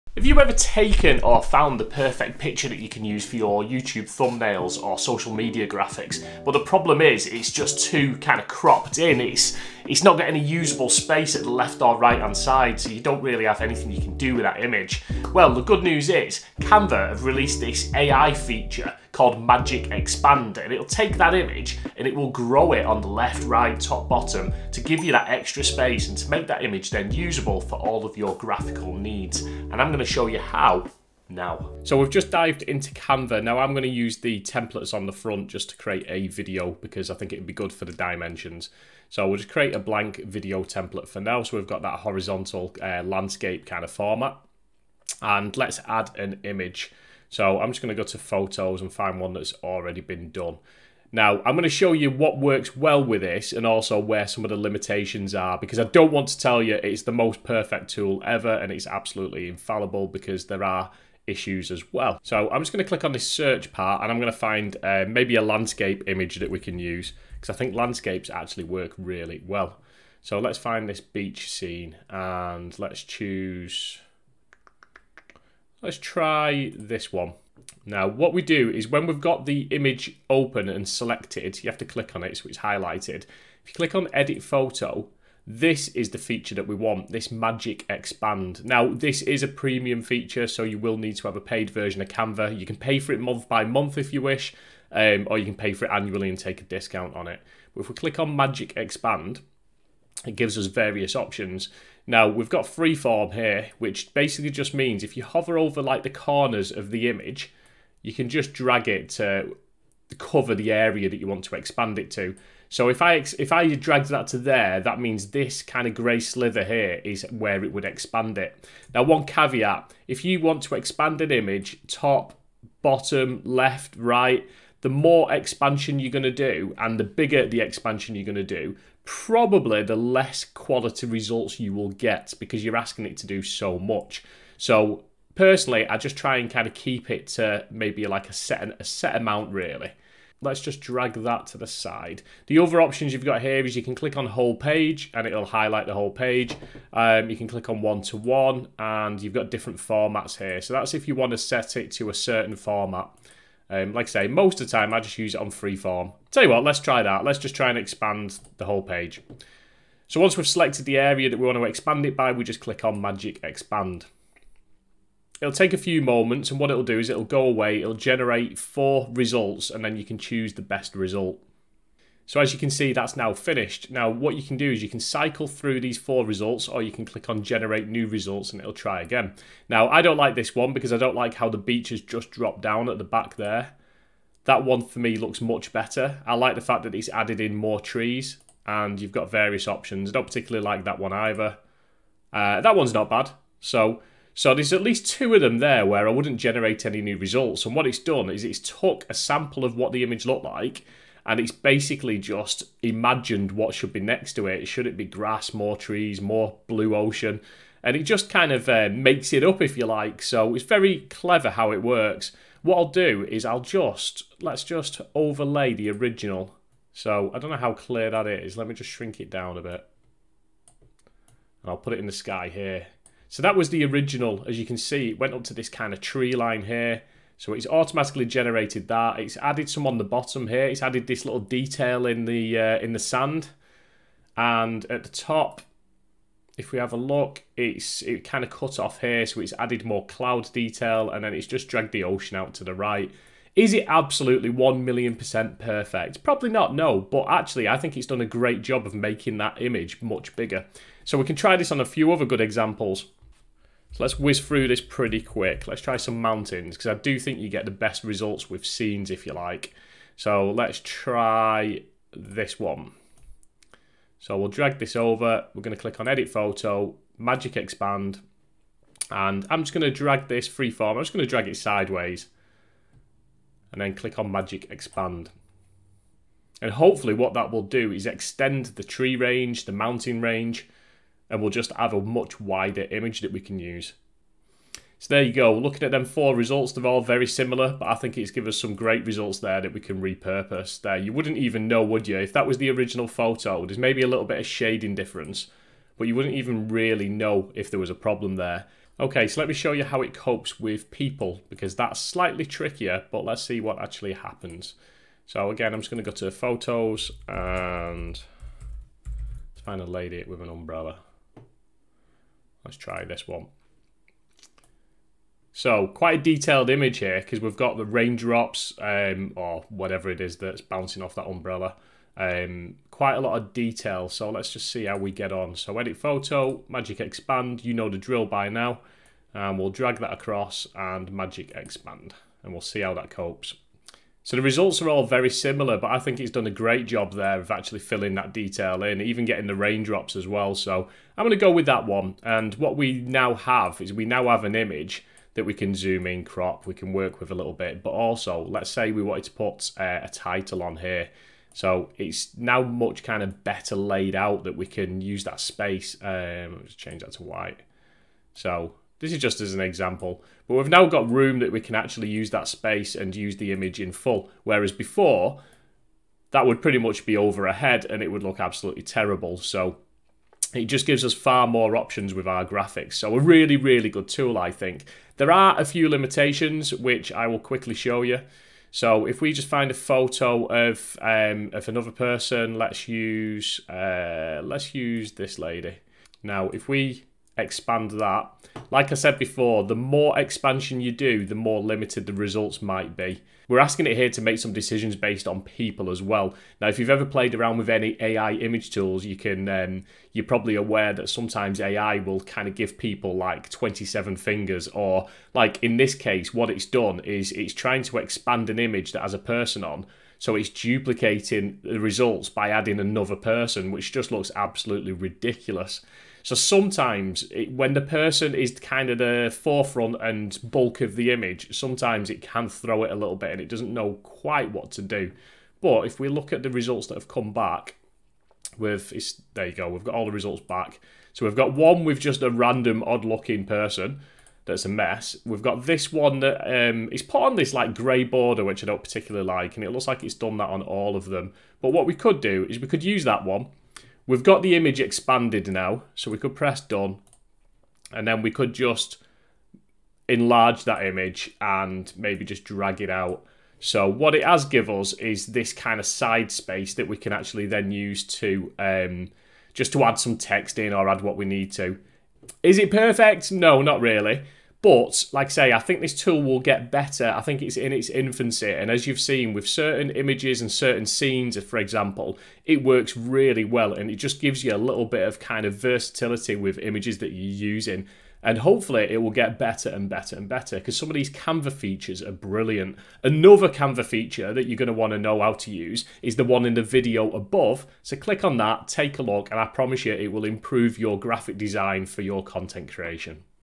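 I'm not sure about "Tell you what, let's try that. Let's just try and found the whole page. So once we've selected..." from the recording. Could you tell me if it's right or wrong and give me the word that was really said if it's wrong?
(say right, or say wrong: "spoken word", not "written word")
wrong: "expand", not "found".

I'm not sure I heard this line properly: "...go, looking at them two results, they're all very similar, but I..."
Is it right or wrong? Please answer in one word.
wrong.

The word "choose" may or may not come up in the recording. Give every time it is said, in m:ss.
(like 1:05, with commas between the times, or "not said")
1:13, 2:50.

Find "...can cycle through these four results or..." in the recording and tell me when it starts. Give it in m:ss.
2:54.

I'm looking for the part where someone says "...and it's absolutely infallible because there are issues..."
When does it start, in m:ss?
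0:58.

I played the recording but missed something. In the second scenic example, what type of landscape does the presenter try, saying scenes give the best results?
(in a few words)
mountains.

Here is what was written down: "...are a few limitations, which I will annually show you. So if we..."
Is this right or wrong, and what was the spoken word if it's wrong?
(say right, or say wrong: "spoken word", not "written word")
wrong: "quickly", not "annually".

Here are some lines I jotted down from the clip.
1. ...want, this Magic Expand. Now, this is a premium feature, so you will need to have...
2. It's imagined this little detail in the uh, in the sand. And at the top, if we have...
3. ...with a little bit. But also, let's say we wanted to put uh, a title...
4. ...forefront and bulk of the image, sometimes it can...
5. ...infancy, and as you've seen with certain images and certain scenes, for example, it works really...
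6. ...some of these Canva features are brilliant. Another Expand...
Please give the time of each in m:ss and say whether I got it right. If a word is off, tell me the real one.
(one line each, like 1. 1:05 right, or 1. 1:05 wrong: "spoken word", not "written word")
1. 1:26 right
2. 3:50 wrong: "added", not "imagined"
3. 5:47 right
4. 6:59 right
5. 7:47 right
6. 8:00 wrong: "Canva", not "Expand".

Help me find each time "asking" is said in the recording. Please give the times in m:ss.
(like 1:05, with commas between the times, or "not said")
2:12, 6:33.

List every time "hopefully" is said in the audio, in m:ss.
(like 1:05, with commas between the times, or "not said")
4:36, 7:58.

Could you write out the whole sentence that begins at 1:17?
Now, what we do is when we've got the image open and selected, you have to click on it so it's highlighted.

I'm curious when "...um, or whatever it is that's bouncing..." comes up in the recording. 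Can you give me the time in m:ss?
5:18.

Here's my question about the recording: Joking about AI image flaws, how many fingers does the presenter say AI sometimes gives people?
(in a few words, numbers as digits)
27.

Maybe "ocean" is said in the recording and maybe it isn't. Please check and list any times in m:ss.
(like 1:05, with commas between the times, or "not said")
3:26, 4:02.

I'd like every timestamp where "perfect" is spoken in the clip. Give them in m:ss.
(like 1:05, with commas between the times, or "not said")
0:01, 0:57, 4:05, 7:42.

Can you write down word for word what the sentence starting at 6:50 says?
So it's duplicating the results by adding another person, which just looks absolutely ridiculous.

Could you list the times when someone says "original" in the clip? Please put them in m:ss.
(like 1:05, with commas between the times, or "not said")
3:35, 3:43, 4:52.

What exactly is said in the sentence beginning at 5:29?
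And we'll drag that across and magic expand.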